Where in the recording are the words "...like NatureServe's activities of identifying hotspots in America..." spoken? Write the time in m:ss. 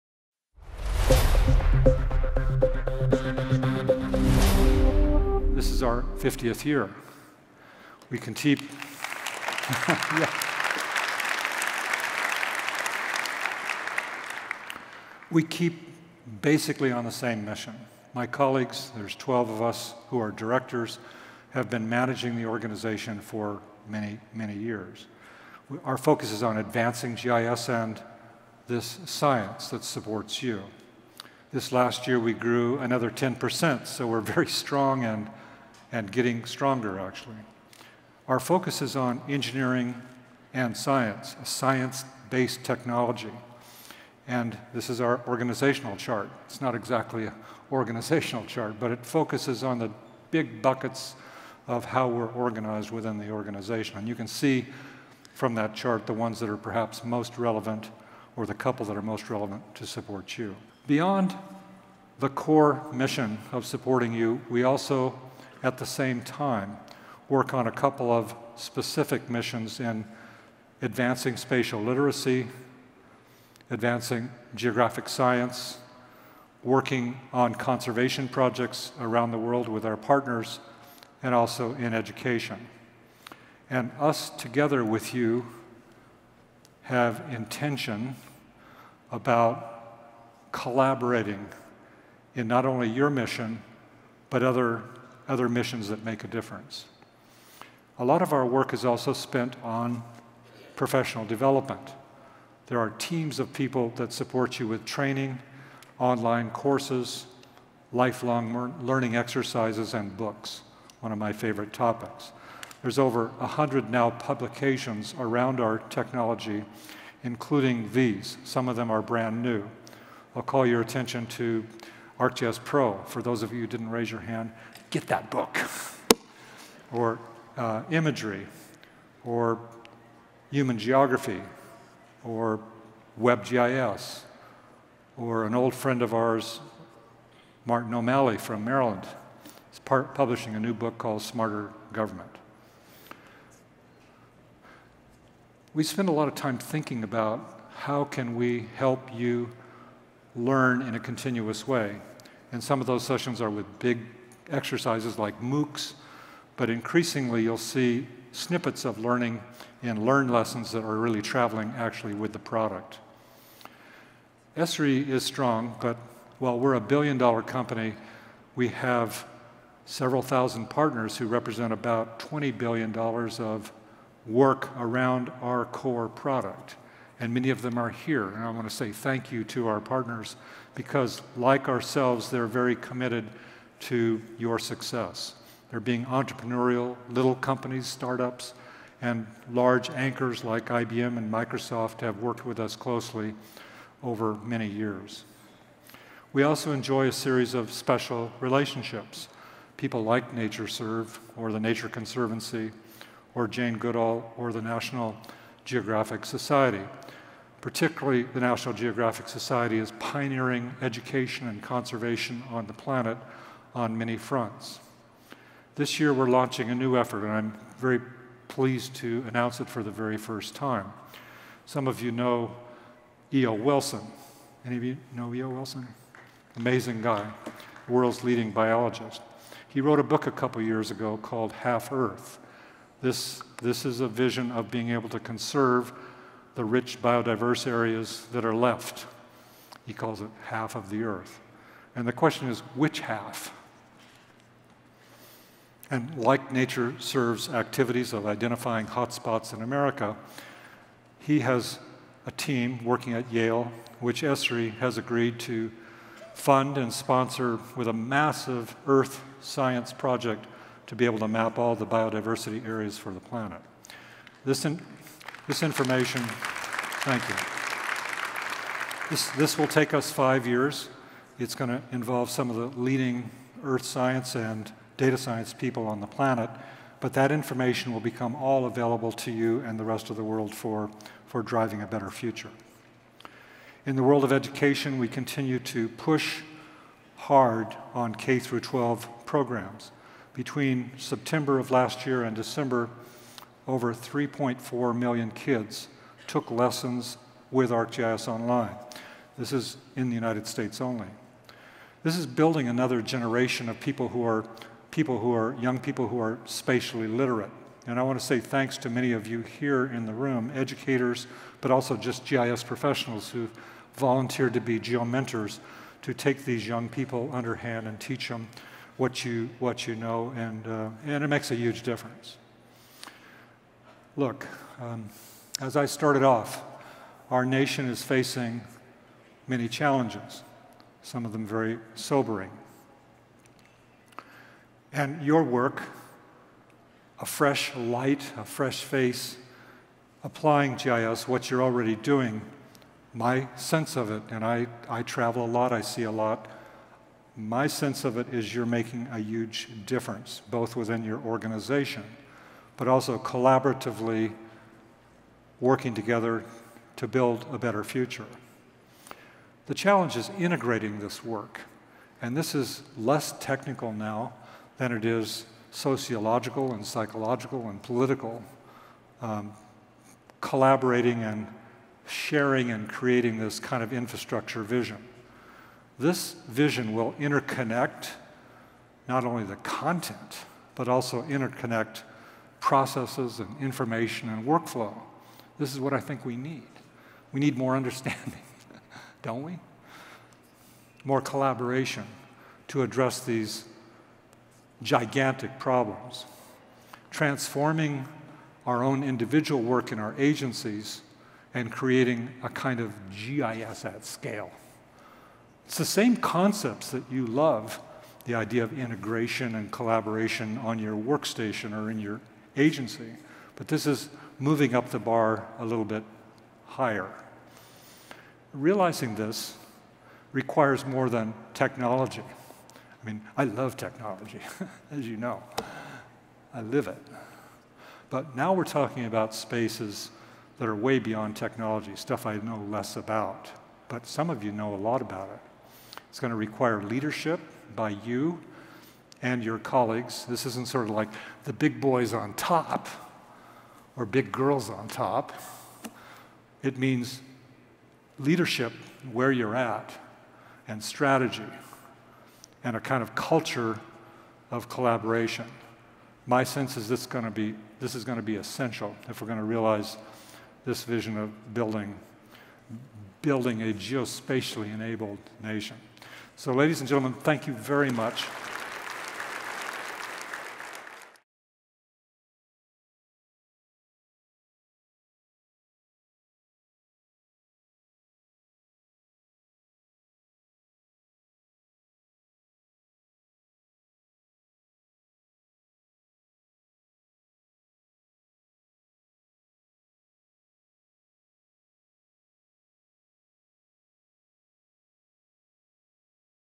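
4:06.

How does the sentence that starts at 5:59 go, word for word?
The challenge is integrating this work.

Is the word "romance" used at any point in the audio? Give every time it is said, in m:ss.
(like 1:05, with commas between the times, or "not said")
not said.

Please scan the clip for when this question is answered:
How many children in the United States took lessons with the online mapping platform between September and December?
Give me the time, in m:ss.
4:53.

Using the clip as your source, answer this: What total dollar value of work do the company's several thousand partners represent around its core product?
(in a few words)
$20 billion.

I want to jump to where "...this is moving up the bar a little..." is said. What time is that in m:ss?
6:53.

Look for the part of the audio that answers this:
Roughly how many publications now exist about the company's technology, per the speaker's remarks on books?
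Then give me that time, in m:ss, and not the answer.
1:52.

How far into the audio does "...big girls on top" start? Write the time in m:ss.
7:24.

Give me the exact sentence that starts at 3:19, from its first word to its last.
People like NatureServe or the Nature Conservancy or Jane Goodall or the National Geographic Society.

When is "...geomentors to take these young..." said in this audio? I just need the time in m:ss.
5:14.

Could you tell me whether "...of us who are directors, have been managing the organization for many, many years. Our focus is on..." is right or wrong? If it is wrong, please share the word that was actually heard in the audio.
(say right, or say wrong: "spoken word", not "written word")
right.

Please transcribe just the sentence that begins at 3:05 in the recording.
They're being entrepreneurial, little companies, startups, and large anchors like IBM and Microsoft have worked with us closely over many years.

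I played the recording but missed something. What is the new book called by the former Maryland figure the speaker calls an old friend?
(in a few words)
Smarter Government.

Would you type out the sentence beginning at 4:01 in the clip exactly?
And the question is, which half?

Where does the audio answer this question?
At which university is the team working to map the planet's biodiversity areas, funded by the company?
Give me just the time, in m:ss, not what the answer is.
4:13.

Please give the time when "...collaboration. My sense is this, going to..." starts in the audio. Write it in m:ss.
7:34.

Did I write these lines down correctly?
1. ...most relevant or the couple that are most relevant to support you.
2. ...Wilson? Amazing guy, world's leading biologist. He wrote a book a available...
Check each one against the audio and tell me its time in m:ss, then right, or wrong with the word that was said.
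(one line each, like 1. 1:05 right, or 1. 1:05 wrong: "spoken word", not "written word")
1. 0:57 right
2. 3:45 wrong: "couple", not "available".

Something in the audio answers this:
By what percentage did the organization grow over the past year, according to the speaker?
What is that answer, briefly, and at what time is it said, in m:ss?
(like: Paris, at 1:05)
10%, at 0:33.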